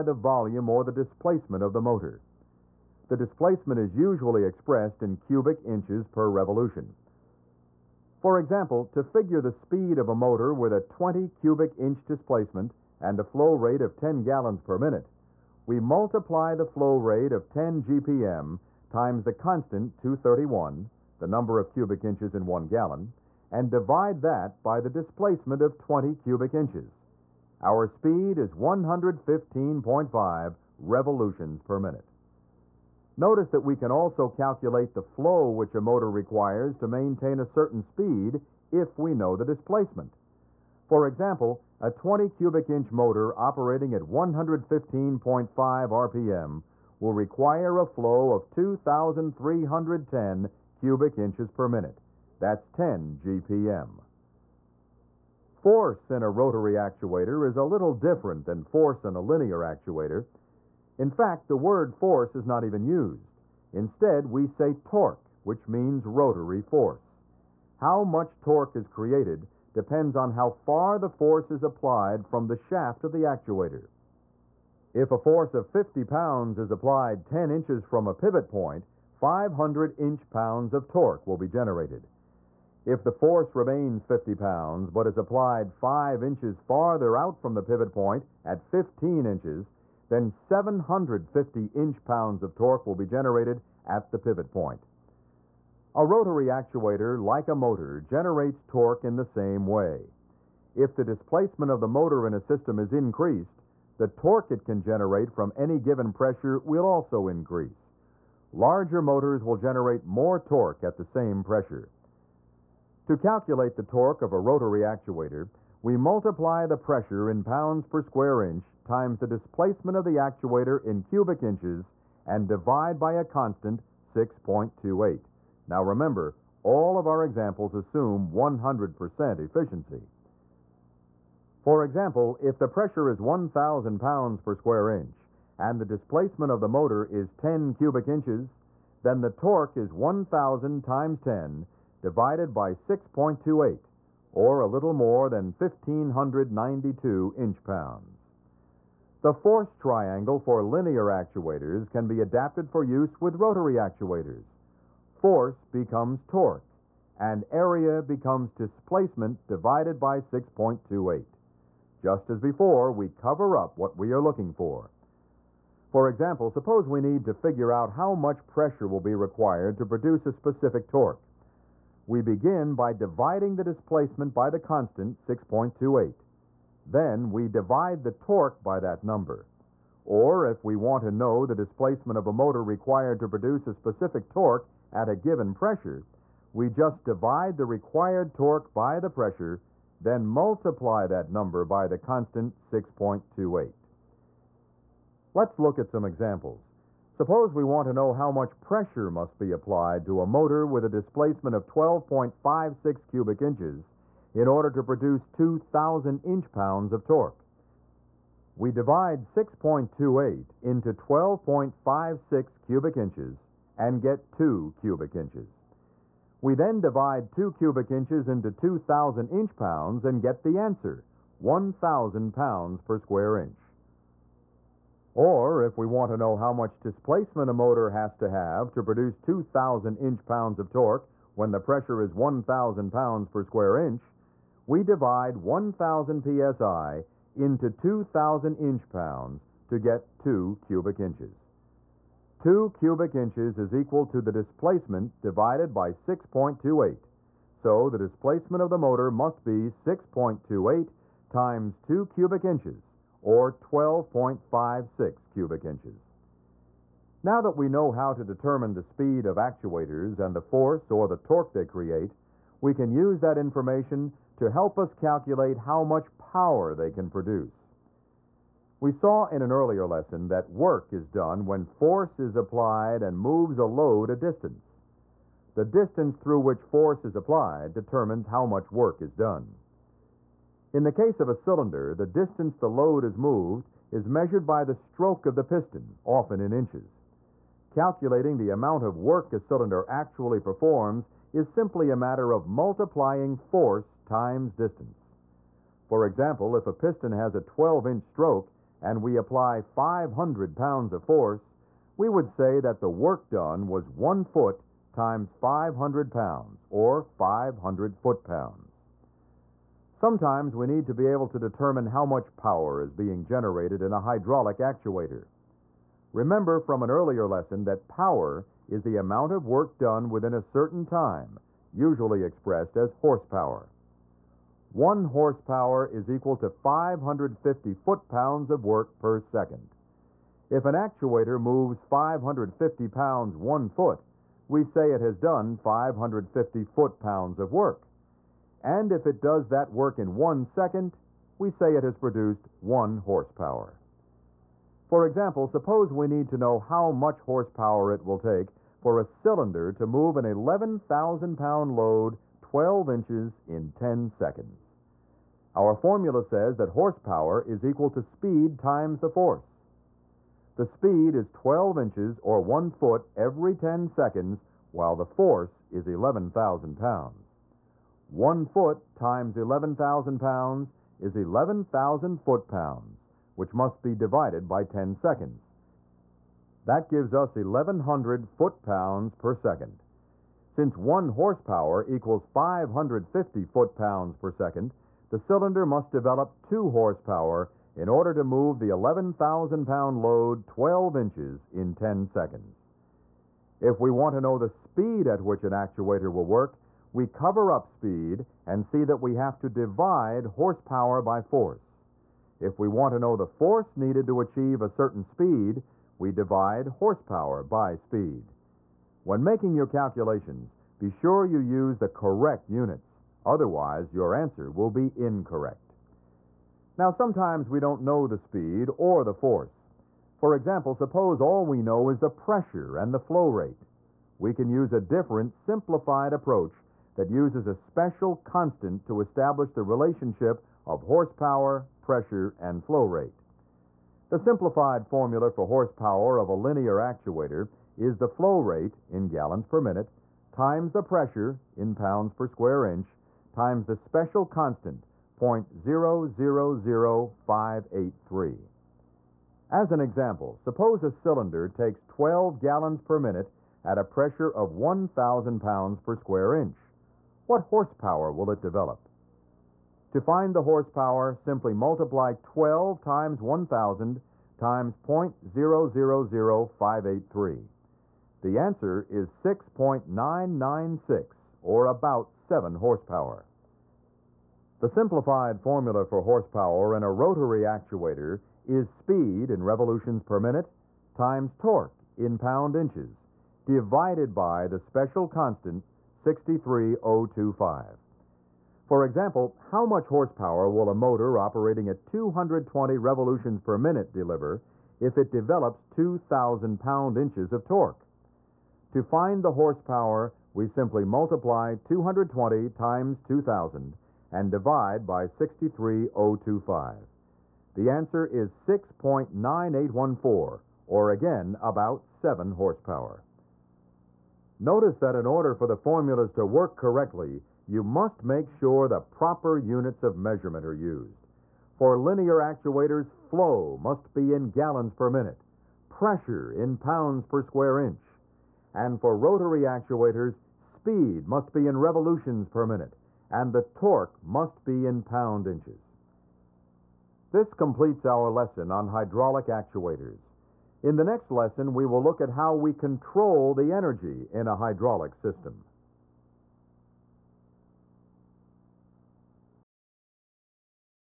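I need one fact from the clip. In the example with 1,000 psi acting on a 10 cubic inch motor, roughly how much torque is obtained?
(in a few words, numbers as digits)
1,592 inch-pounds.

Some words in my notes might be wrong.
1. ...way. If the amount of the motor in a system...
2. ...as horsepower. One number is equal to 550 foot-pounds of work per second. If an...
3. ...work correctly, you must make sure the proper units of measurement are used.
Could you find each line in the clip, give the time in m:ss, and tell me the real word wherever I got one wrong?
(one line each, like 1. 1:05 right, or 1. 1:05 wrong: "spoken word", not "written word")
1. 1:39 wrong: "displacement", not "amount"
2. 5:22 wrong: "horsepower", not "number"
3. 8:36 right.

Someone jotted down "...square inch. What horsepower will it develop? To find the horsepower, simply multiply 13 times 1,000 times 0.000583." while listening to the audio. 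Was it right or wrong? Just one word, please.
wrong.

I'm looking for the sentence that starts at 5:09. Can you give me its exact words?
Sometimes we need to be able to determine how much power is being generated in a hydraulic actuator.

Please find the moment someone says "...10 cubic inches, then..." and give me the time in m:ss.
2:17.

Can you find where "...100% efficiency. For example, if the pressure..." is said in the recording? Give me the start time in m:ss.
2:08.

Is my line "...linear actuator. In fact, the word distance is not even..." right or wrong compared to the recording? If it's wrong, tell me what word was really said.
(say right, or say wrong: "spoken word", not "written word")
wrong: "force", not "distance".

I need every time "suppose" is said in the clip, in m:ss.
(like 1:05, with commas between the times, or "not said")
2:46, 3:17, 5:45, 7:00, 7:30.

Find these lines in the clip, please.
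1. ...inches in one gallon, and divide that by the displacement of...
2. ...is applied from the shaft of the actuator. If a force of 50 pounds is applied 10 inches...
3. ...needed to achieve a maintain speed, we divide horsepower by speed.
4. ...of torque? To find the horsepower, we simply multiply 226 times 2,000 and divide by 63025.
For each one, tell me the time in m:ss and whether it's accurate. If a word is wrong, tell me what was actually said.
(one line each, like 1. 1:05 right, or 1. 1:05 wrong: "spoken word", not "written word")
1. 0:22 right
2. 1:11 right
3. 6:43 wrong: "certain", not "maintain"
4. 8:17 wrong: "220", not "226".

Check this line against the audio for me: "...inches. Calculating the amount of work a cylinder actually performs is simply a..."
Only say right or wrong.
right.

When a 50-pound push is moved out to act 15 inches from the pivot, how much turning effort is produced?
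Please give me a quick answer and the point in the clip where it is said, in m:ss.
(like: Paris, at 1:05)
750 inch-pounds, at 1:30.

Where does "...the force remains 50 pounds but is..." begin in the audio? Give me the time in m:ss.
1:23.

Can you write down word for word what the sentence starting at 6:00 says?
The speed is 12 inches or one foot every 10 seconds, while the force is 11,000 pounds.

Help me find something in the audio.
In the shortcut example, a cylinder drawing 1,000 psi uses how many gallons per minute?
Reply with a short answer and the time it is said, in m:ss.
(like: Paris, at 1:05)
12, at 7:31.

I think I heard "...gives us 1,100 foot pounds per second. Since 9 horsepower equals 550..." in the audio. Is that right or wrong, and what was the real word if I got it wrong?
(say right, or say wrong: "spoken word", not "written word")
wrong: "1", not "9".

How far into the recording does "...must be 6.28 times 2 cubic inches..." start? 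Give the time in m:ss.
4:09.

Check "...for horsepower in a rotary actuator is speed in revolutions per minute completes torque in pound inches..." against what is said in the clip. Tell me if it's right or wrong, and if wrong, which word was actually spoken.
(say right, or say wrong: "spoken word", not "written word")
wrong: "times", not "completes".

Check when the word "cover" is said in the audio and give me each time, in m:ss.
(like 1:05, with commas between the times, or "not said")
2:43, 6:37.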